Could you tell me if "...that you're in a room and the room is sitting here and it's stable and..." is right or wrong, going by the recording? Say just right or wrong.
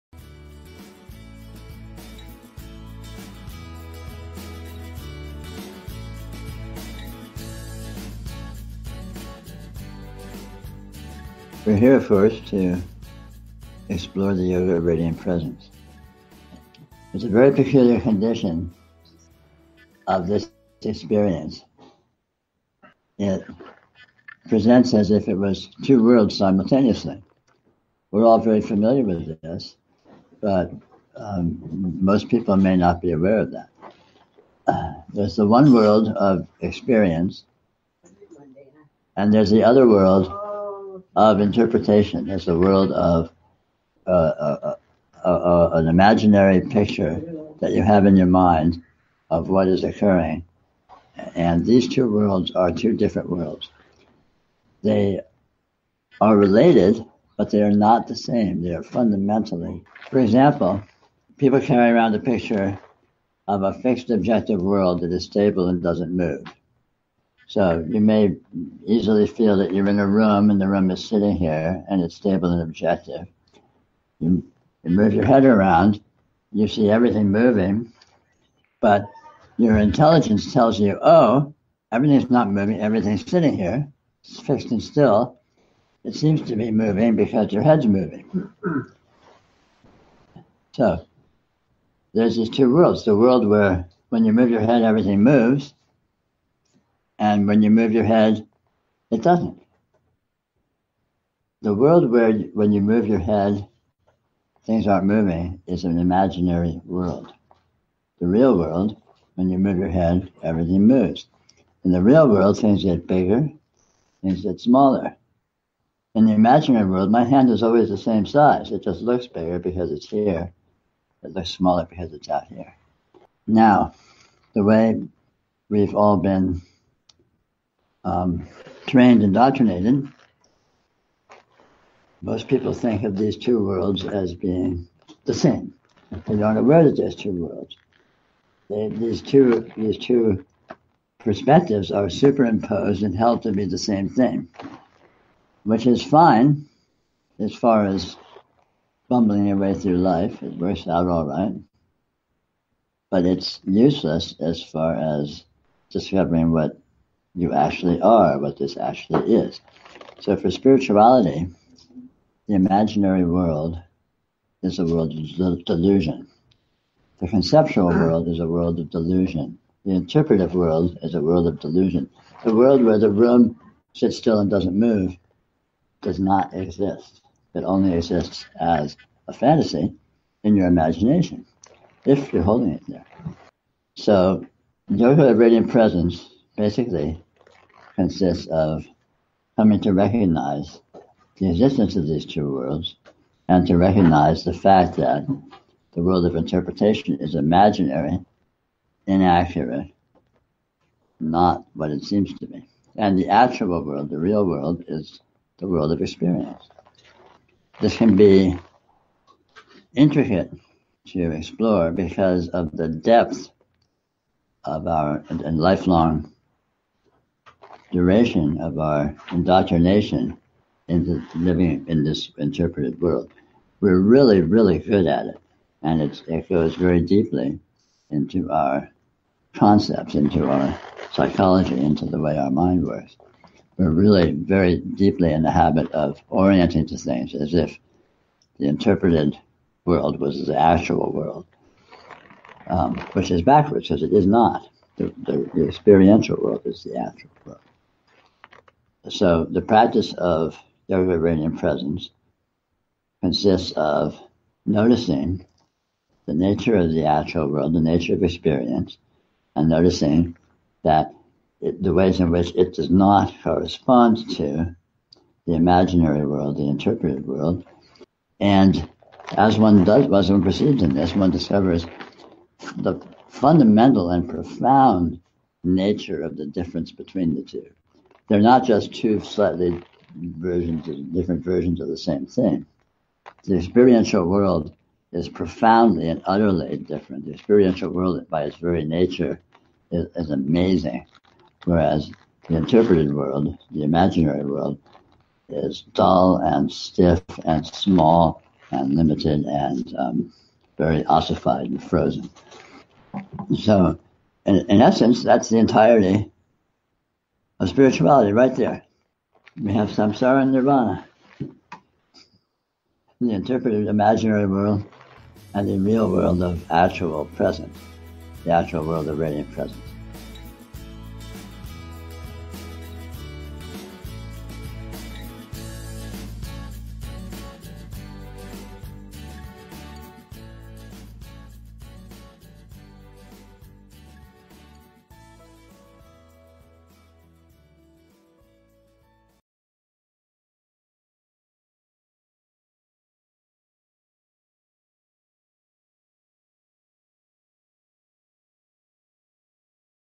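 right.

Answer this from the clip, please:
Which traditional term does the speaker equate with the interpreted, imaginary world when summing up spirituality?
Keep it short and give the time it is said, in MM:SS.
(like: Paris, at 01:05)
samsara, at 05:09.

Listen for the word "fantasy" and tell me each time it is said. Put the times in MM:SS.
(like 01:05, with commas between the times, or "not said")
02:59.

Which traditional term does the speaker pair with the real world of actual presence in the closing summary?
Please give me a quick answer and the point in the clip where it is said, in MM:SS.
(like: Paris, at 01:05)
nirvana, at 05:10.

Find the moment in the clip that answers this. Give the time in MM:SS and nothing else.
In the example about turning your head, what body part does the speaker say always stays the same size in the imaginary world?
01:57.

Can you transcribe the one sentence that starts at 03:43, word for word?
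We're really, really good at it.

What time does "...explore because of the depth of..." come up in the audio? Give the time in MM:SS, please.
03:31.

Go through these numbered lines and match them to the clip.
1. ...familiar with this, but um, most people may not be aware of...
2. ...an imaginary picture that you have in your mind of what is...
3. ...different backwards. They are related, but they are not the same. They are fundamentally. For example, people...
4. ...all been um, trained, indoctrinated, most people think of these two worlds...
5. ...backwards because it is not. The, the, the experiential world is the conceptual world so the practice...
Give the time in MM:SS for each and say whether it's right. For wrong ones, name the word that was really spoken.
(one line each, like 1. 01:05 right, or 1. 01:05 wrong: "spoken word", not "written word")
1. 00:28 right
2. 00:45 right
3. 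00:52 wrong: "worlds", not "backwards"
4. 02:05 right
5. 04:03 wrong: "actual", not "conceptual".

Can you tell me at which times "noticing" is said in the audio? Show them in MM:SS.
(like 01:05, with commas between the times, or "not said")
04:14, 04:19.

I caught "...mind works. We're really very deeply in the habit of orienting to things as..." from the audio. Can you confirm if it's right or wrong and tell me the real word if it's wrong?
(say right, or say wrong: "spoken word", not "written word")
right.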